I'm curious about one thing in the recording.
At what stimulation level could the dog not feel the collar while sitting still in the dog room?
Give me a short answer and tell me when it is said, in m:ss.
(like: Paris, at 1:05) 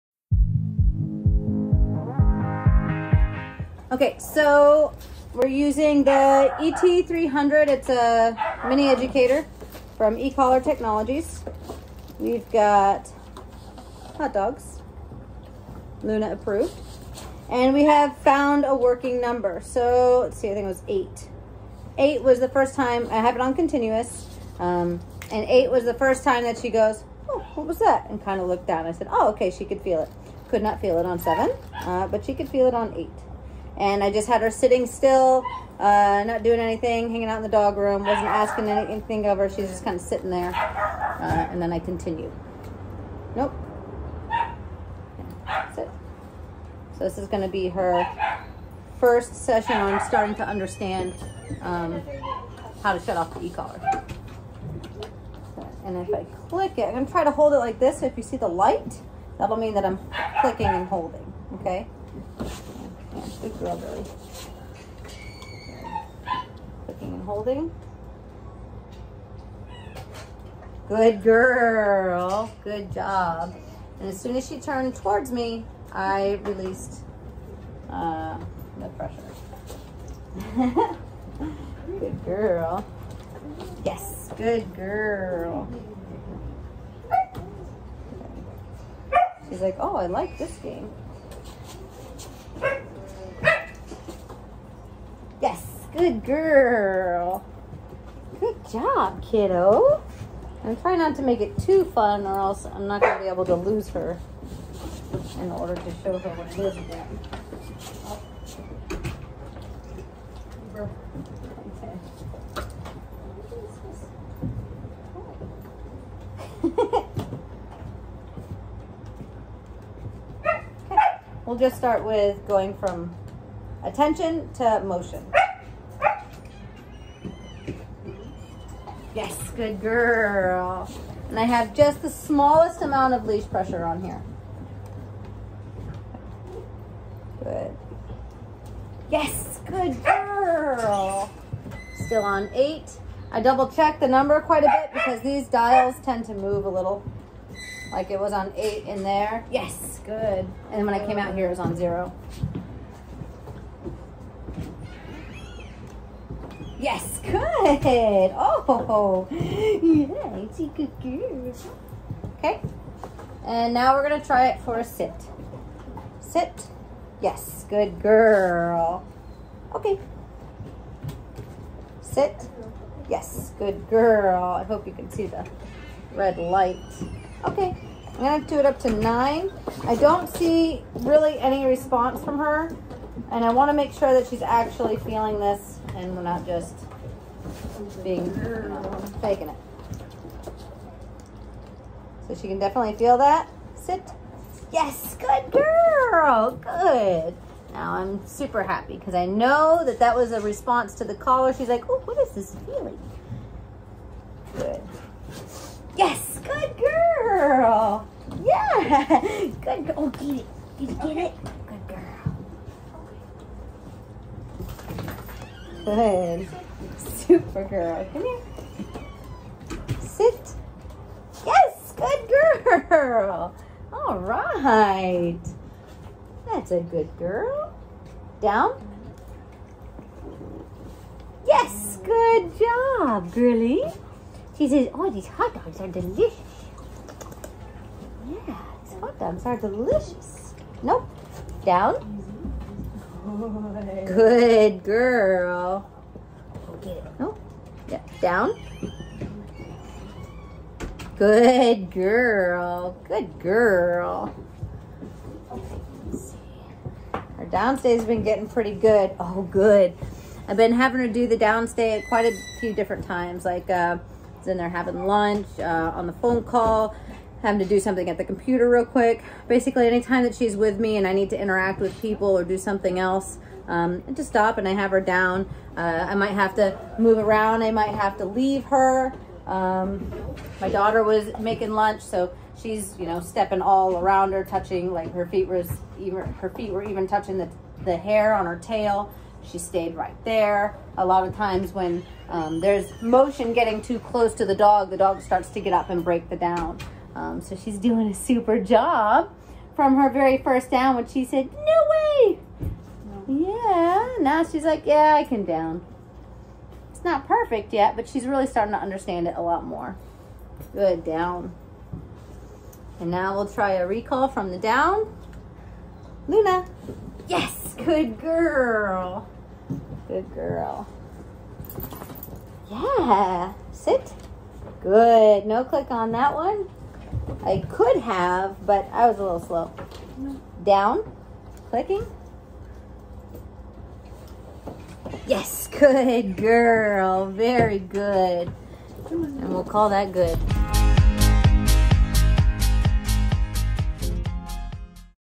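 7, at 0:31.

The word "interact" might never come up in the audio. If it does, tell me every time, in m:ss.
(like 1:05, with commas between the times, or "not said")
4:31.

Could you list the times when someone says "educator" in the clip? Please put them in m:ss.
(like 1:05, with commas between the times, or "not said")
0:08.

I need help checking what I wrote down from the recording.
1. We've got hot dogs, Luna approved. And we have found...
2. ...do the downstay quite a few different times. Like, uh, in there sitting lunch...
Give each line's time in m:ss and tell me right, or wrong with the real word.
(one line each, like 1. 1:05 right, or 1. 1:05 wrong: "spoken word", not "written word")
1. 0:12 right
2. 4:21 wrong: "having", not "sitting".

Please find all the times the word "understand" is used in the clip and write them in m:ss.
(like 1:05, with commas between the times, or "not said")
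0:50, 5:08.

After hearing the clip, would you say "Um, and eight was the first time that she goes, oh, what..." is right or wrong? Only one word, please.
right.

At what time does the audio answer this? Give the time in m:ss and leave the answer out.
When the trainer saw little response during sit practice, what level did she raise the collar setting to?
2:58.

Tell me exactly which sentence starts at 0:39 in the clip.
She's just kind of sitting there, uh, and then I continued.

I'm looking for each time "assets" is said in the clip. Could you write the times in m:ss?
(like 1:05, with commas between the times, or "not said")
not said.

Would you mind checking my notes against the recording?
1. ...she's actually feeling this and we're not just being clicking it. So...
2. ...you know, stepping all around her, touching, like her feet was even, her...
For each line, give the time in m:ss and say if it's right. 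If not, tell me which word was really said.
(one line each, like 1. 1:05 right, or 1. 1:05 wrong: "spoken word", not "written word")
1. 3:04 wrong: "faking", not "clicking"
2. 4:42 right.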